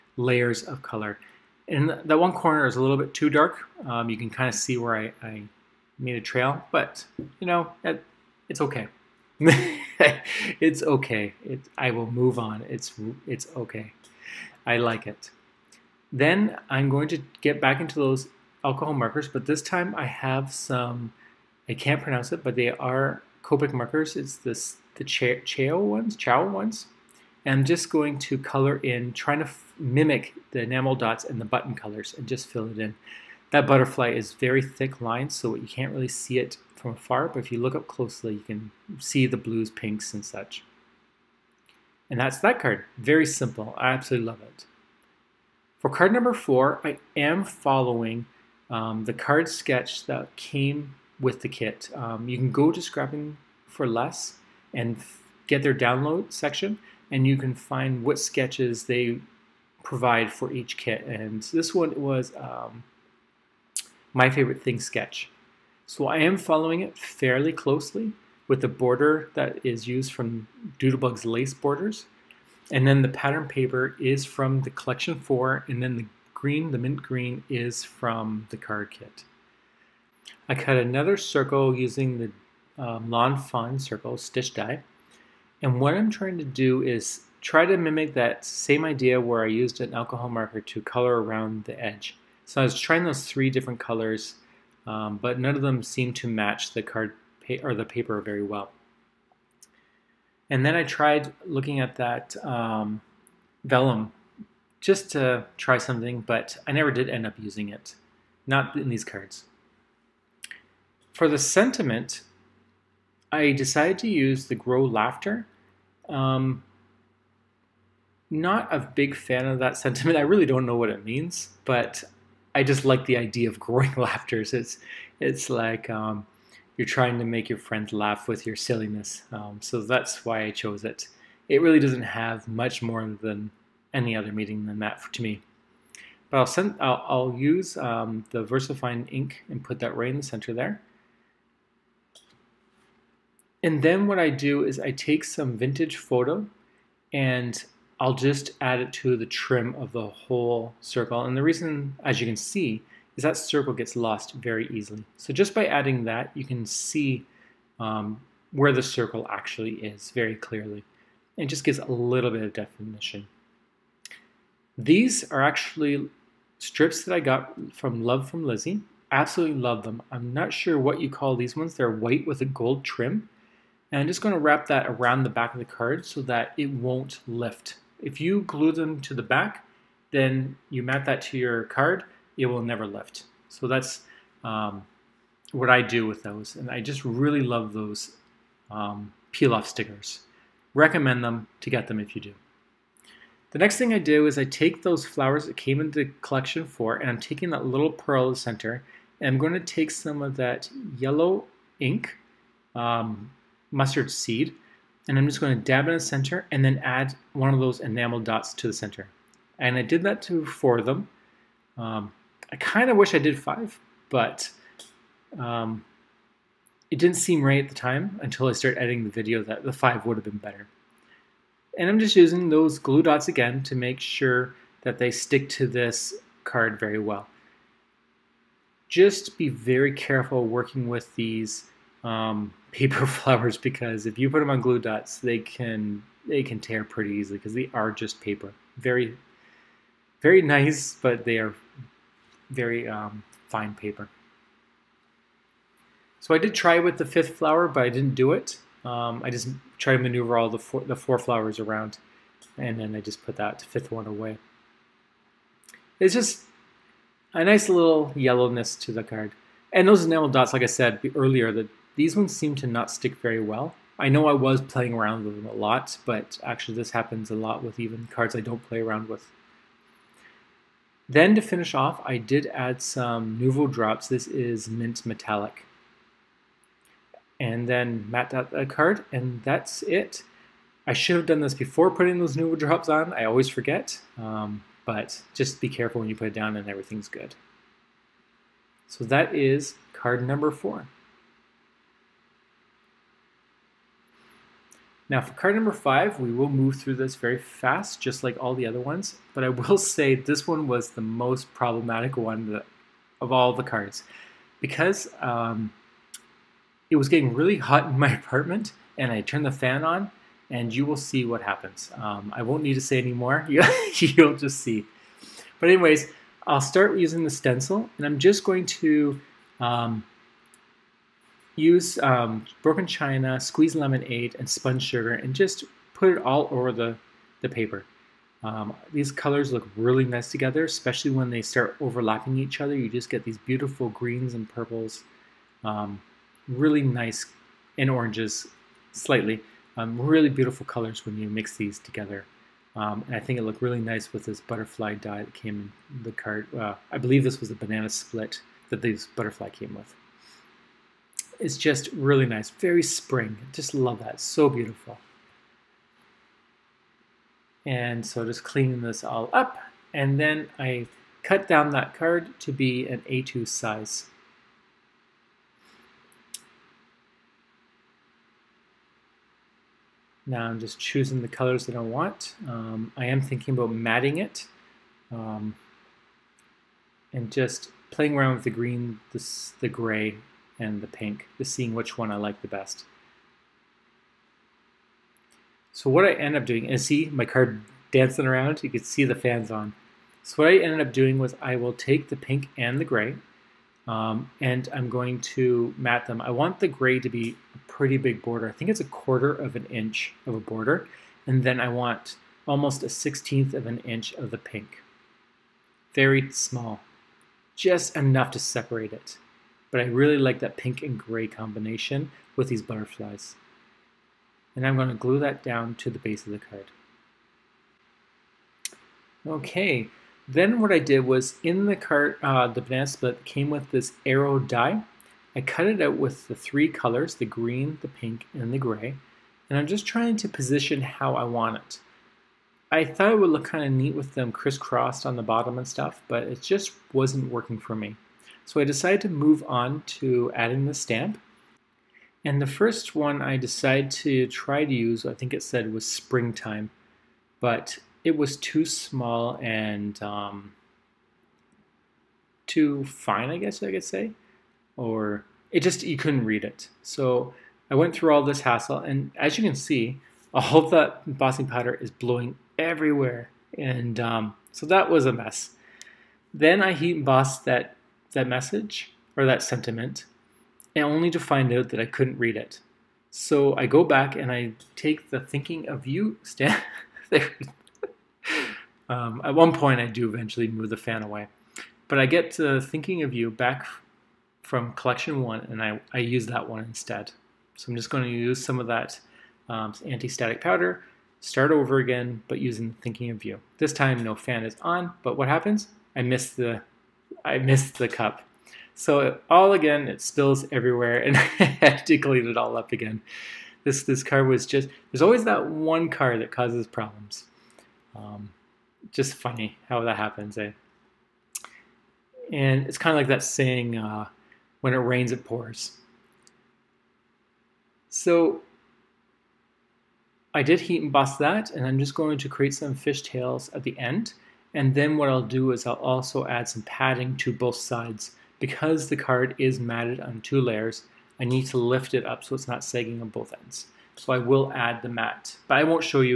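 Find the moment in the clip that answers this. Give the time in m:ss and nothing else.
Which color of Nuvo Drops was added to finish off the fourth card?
4:34.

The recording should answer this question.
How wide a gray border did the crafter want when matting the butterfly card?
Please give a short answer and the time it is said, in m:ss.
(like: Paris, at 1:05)
a quarter of an inch, at 6:38.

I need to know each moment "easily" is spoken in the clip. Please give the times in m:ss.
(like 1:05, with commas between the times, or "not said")
2:34, 3:57.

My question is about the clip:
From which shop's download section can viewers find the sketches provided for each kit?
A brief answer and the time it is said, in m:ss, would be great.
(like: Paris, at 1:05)
Scrapping for Less, at 0:52.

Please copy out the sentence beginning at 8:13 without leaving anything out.
This time, no fan is on, but what happens?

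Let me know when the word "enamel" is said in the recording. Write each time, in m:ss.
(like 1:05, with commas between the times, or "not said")
0:30, 3:27, 4:20.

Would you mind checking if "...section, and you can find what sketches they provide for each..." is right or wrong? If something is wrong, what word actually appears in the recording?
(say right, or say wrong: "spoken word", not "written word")
right.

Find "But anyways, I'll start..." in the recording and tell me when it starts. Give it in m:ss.
5:15.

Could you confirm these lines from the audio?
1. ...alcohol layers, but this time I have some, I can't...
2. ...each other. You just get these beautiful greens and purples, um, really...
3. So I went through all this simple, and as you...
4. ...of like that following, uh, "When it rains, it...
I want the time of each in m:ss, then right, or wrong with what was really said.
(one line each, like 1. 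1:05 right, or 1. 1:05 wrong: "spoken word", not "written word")
1. 0:18 wrong: "markers", not "layers"
2. 5:32 right
3. 7:36 wrong: "hassle", not "simple"
4. 8:32 wrong: "saying", not "following".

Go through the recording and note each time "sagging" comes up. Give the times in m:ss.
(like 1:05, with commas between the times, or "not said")
8:52.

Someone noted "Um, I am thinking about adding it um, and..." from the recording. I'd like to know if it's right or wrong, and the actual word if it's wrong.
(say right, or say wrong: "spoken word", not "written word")
wrong: "matting", not "adding".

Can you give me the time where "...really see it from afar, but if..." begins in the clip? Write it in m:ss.
0:35.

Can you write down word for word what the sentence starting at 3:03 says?
So that's um, what I do with those.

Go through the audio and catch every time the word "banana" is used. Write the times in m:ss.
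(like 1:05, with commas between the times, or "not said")
5:47, 7:02.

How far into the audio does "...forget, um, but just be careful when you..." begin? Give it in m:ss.
4:43.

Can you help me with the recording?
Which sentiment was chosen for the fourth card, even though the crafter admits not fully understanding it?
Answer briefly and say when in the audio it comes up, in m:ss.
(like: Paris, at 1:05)
Grow Laughter, at 1:54.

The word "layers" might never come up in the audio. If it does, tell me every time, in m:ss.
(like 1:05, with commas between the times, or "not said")
0:00, 8:50.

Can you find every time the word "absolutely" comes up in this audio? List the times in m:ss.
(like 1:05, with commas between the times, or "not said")
0:43, 2:49.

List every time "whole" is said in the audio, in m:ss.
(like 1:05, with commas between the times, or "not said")
2:30.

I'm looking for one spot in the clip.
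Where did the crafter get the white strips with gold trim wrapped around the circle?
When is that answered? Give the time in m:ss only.
2:48.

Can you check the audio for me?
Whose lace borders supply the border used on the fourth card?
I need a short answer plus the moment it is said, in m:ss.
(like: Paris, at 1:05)
Doodlebug, at 1:10.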